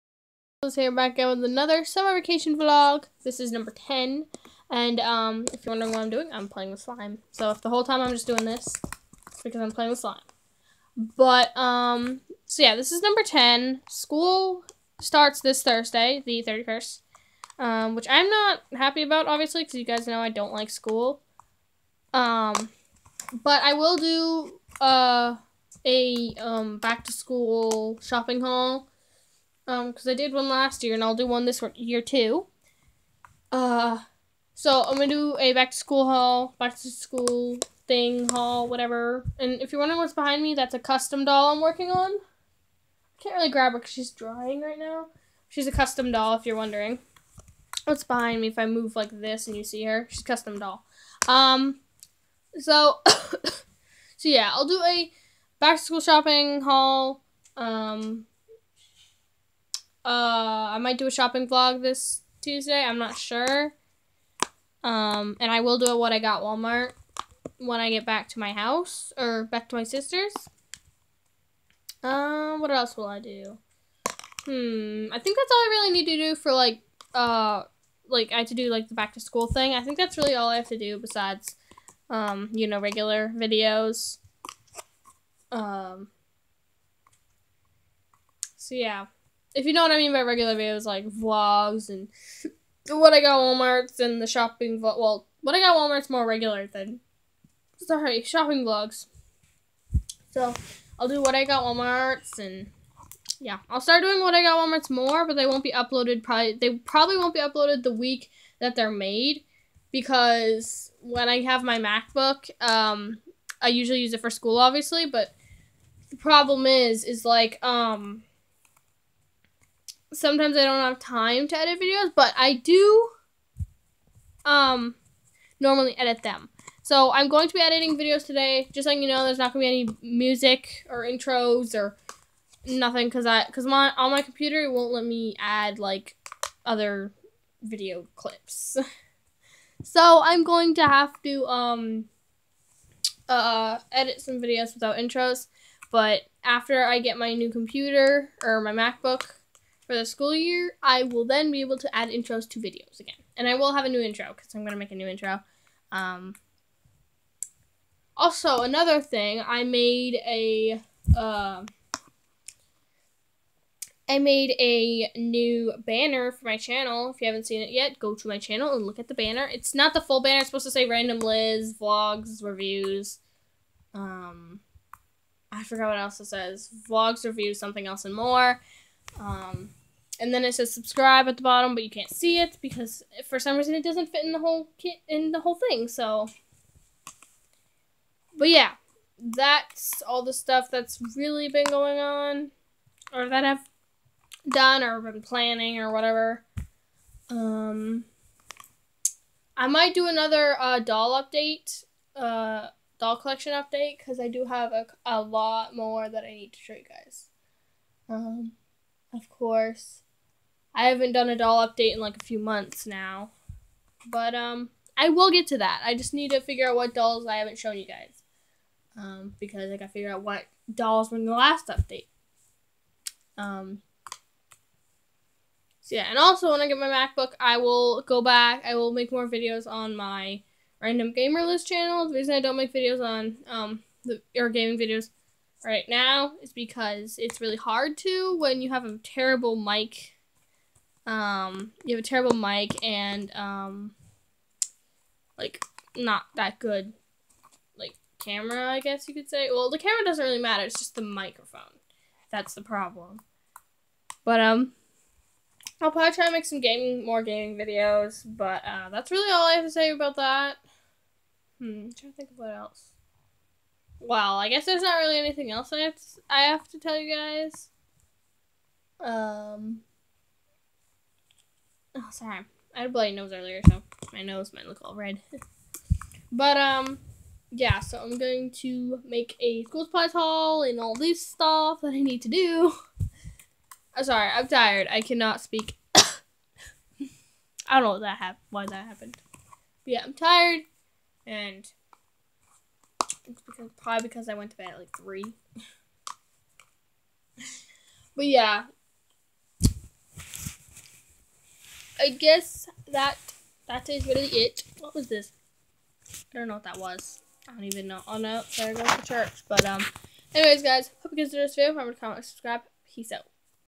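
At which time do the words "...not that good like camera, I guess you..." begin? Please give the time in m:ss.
4:05.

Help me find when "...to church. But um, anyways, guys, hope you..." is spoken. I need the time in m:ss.
5:08.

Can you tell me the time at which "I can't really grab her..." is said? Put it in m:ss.
0:42.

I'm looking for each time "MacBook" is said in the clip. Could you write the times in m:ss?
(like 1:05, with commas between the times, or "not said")
1:51, 2:28, 3:46.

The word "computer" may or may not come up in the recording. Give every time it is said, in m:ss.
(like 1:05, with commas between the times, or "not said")
2:14, 2:27.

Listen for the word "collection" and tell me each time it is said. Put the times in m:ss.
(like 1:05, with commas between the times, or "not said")
3:23.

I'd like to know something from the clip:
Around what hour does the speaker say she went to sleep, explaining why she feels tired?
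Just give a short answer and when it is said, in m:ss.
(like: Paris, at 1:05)
3, at 4:54.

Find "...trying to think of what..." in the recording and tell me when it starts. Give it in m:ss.
4:21.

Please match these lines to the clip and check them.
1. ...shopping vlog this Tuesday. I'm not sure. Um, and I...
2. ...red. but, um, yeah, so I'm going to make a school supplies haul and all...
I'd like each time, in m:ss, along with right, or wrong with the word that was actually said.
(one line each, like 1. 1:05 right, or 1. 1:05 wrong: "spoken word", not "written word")
1. 1:01 right
2. 4:34 right.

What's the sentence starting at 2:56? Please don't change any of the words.
Vlogs, Reviews, something else and more.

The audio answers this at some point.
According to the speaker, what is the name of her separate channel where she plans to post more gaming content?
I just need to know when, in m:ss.
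3:50.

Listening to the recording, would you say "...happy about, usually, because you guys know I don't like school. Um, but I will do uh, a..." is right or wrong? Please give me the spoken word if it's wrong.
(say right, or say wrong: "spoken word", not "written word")
wrong: "obviously", not "usually".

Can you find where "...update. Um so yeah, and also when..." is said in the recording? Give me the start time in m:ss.
3:41.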